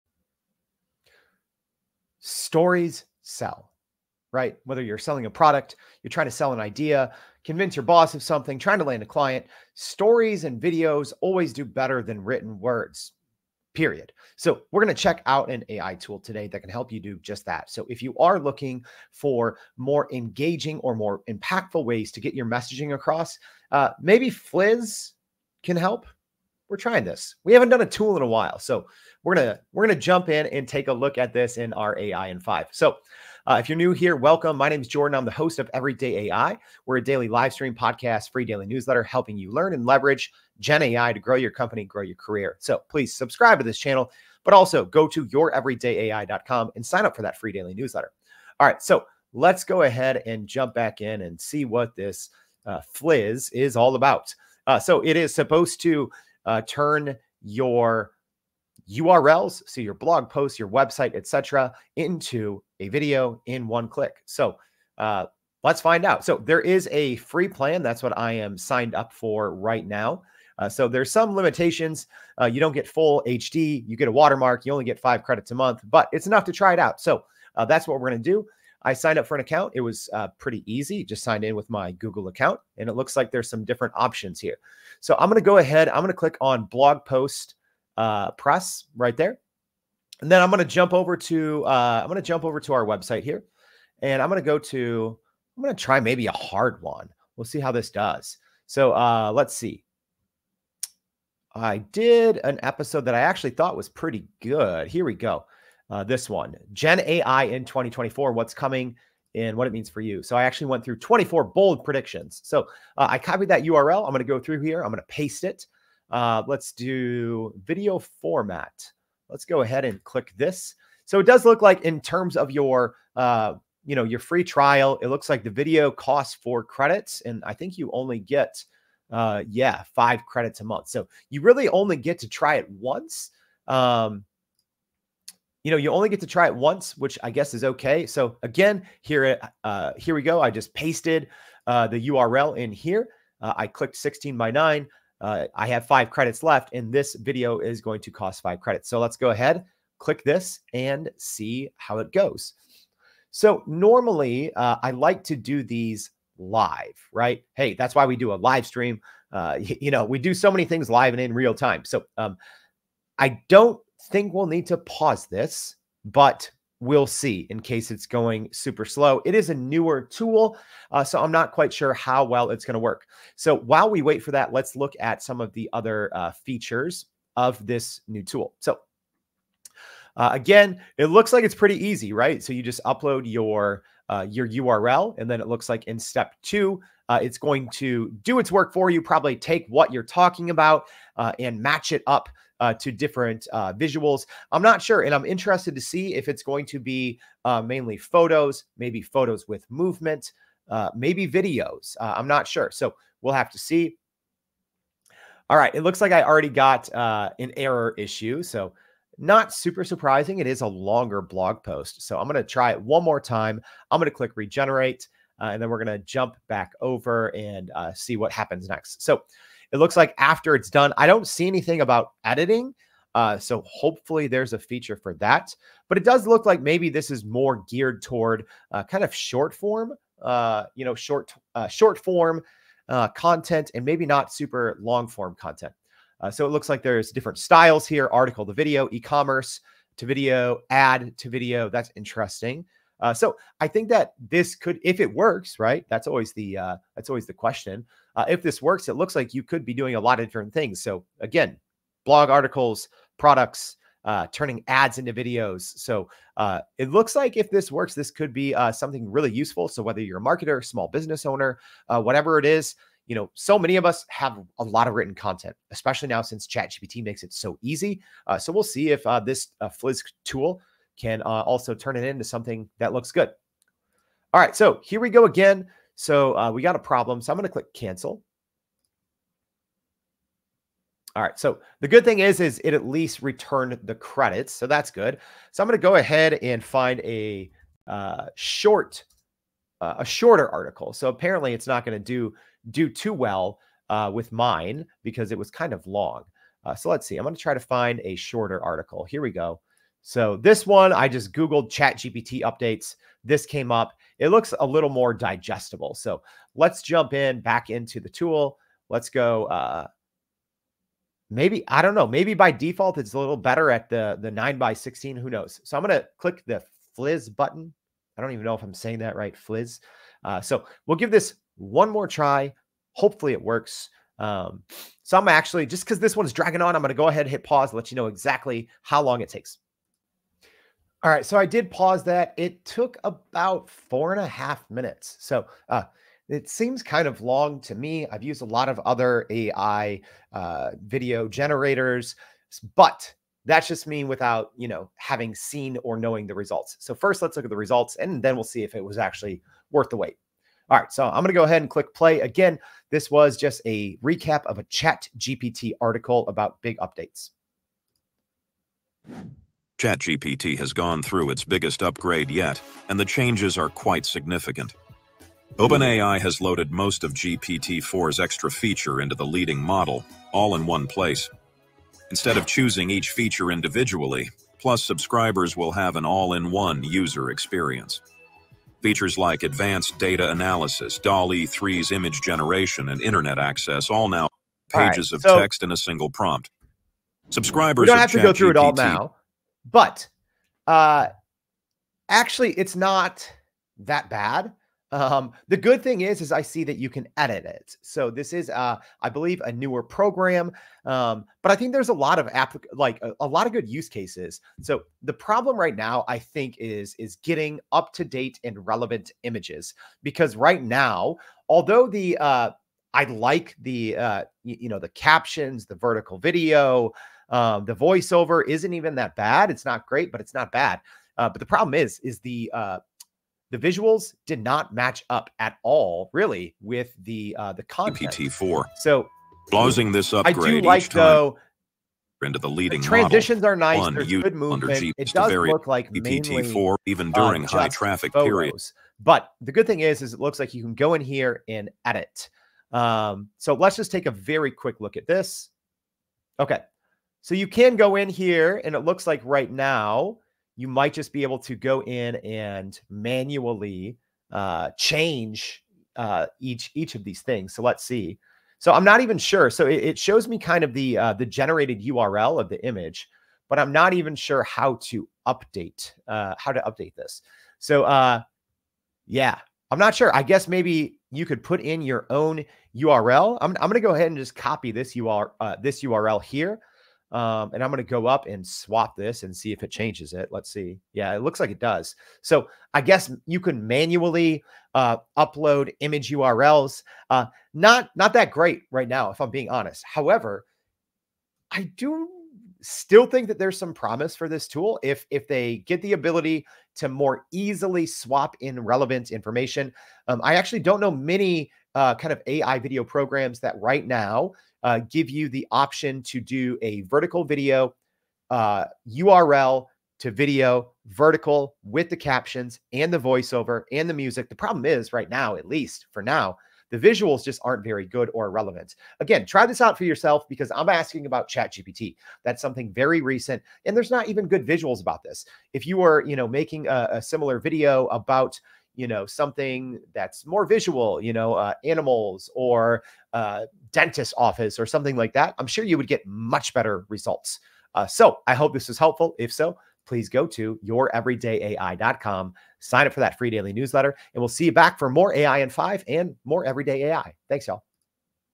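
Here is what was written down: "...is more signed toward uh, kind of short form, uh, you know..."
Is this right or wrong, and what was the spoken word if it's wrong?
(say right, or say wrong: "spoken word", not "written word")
wrong: "geared", not "signed".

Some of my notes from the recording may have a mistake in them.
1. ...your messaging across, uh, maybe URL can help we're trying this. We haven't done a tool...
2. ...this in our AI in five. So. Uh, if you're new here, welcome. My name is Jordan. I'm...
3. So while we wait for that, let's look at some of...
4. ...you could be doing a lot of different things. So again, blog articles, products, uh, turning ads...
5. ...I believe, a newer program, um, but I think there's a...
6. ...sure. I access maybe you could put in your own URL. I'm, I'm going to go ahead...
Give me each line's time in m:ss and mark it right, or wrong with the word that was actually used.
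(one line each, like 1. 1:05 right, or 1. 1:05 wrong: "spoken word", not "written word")
1. 0:22 wrong: "Fliz", not "URL"
2. 0:31 right
3. 2:53 right
4. 4:09 right
5. 6:39 right
6. 7:49 wrong: "guess", not "access".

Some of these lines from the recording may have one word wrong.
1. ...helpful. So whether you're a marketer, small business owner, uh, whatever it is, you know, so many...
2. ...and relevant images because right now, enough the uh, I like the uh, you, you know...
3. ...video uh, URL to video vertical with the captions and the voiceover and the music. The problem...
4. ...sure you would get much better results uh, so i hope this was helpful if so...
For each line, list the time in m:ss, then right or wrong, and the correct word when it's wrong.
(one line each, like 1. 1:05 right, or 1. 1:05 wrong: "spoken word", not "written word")
1. 4:19 wrong: "useful", not "helpful"
2. 6:48 wrong: "although", not "enough"
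3. 8:27 right
4. 8:55 right.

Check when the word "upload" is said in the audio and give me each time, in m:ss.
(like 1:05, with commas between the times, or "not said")
3:02, 8:05.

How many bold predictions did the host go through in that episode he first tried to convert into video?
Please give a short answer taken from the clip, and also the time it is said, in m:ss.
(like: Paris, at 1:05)
24, at 1:50.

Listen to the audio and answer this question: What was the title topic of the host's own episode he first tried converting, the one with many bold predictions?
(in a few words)
Gen AI in 2024.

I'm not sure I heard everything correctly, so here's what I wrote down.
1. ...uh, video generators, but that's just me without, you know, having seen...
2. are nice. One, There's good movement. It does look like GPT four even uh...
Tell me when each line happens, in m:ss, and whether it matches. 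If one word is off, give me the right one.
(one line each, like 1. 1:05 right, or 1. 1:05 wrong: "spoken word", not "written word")
1. 5:40 right
2. 7:13 right.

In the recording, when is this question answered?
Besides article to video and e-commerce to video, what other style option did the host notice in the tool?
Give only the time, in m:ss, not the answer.
4:00.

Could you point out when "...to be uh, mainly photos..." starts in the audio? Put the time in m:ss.
3:16.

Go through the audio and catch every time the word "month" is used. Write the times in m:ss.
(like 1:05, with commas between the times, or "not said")
1:15, 2:10.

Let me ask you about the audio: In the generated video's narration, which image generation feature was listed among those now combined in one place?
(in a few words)
DALL-E 3.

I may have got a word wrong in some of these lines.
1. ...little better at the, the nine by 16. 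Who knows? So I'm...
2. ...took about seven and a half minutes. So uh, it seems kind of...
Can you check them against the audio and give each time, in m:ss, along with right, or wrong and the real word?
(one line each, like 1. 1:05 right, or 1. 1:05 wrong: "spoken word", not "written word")
1. 5:13 right
2. 5:32 wrong: "four", not "seven".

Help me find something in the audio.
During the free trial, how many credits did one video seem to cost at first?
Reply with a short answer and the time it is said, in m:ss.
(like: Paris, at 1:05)
4, at 2:06.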